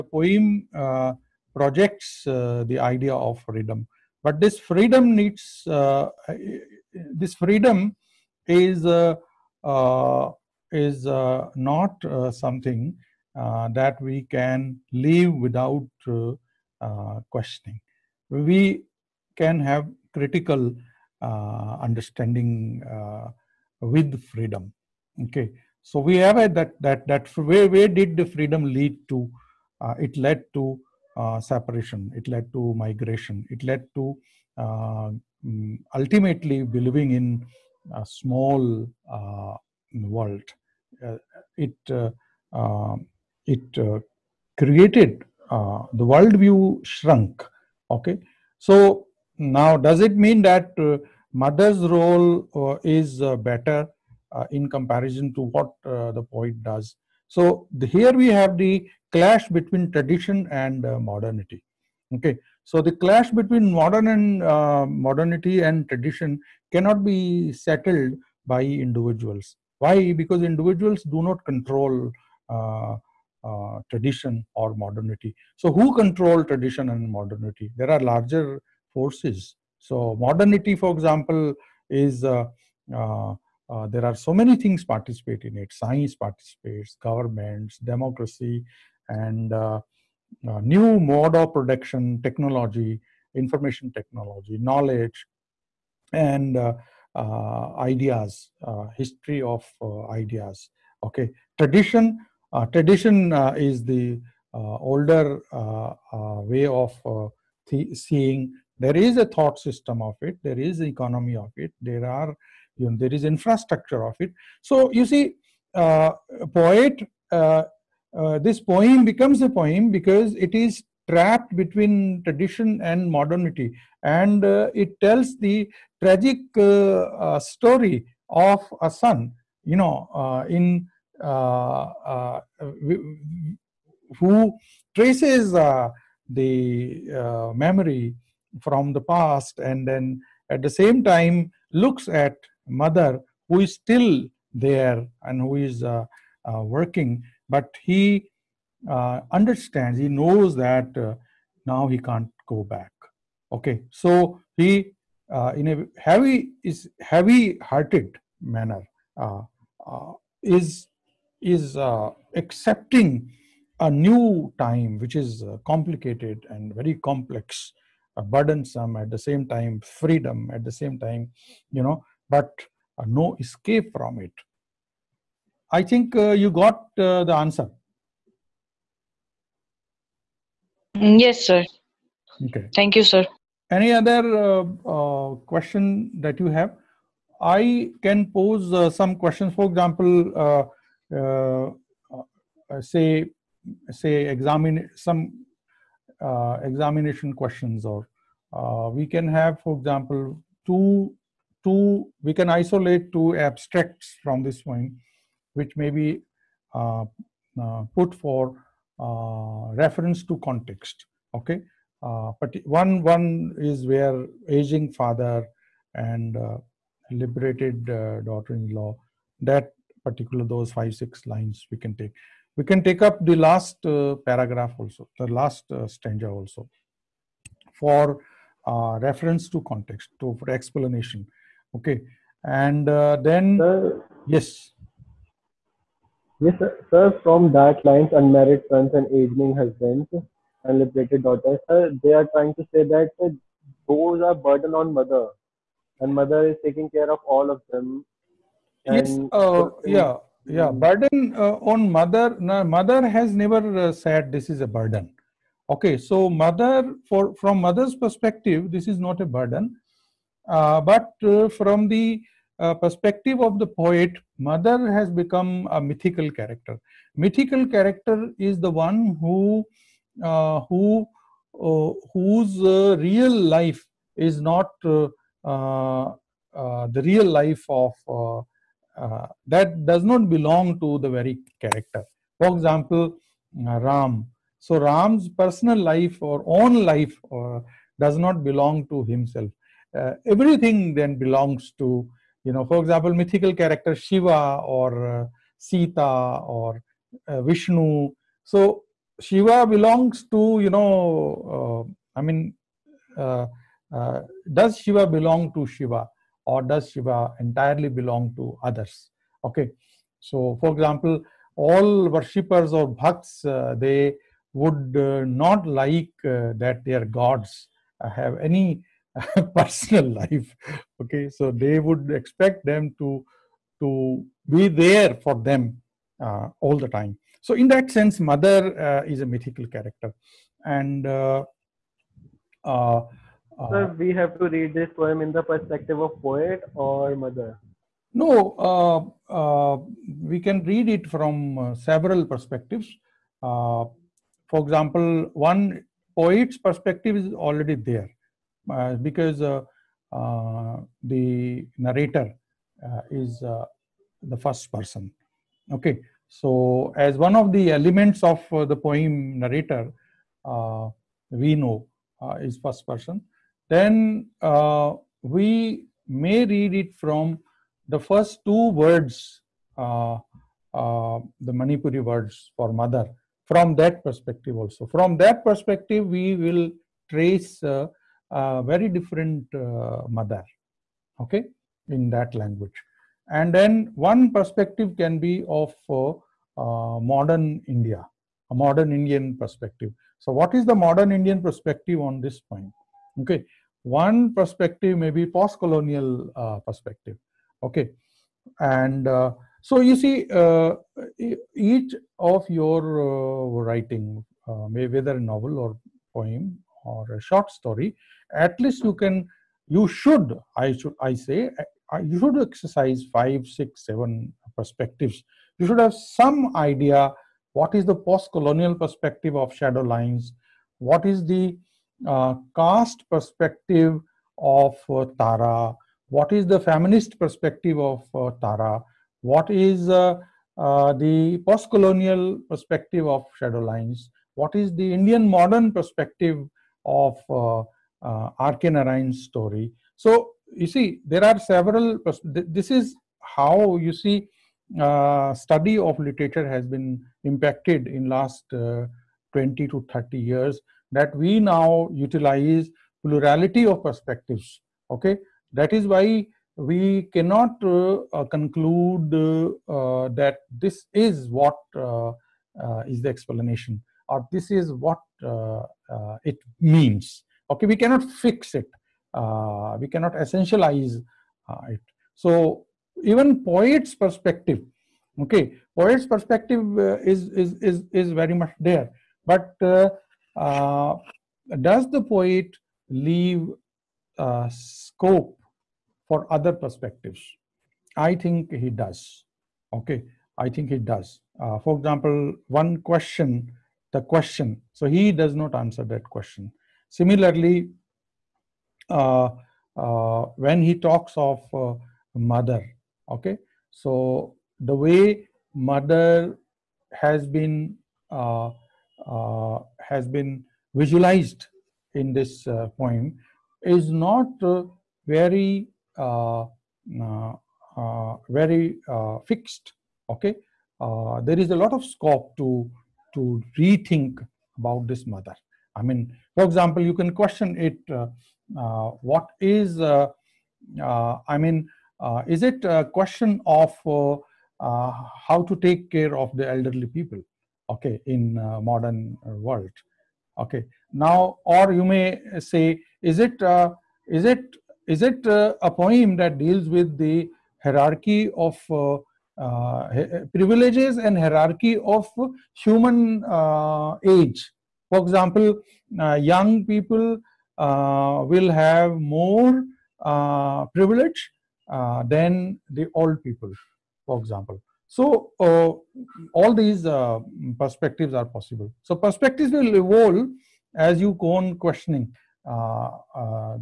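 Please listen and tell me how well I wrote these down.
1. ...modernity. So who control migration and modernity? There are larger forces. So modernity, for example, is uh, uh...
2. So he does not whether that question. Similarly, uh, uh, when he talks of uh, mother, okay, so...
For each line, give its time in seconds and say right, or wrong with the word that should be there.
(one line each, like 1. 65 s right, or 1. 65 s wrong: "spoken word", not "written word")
1. 74 s wrong: "tradition", not "migration"
2. 494 s wrong: "answer", not "whether".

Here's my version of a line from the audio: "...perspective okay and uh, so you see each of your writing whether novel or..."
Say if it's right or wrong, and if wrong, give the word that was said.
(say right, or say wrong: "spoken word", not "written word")
right.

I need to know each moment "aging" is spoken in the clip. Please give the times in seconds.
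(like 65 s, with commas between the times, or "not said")
214 s, 239 s.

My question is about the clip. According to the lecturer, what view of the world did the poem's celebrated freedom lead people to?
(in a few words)
a small world.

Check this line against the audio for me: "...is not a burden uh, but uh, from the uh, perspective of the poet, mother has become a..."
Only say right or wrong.
right.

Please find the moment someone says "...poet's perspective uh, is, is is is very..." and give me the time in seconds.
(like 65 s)
475 s.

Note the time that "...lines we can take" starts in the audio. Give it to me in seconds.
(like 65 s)
221 s.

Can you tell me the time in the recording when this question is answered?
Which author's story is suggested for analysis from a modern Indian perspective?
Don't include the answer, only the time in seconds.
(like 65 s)
438 s.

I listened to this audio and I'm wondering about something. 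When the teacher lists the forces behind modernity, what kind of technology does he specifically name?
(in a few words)
information technology.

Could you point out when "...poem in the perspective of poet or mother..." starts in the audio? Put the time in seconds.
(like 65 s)
334 s.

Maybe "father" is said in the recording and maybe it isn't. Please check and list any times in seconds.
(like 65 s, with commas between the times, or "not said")
214 s.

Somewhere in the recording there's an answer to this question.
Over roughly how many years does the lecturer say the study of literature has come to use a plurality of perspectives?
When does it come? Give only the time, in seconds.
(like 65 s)
449 s.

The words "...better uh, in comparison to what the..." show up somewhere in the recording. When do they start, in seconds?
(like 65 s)
53 s.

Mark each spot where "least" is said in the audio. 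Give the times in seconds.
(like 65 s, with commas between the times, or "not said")
408 s.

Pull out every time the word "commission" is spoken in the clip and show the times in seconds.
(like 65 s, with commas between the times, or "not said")
not said.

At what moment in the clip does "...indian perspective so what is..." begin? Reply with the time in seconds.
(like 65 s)
388 s.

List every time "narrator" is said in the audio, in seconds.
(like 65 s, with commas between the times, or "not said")
351 s, 359 s.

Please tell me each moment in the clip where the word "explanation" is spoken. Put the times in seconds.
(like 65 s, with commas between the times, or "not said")
230 s, 463 s.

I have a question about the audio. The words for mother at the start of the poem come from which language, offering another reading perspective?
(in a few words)
Manipuri.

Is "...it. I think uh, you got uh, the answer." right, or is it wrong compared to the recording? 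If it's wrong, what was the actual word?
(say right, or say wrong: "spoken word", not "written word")
right.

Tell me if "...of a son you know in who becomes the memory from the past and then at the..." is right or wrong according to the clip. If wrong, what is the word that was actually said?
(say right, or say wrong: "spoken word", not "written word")
wrong: "traces", not "becomes".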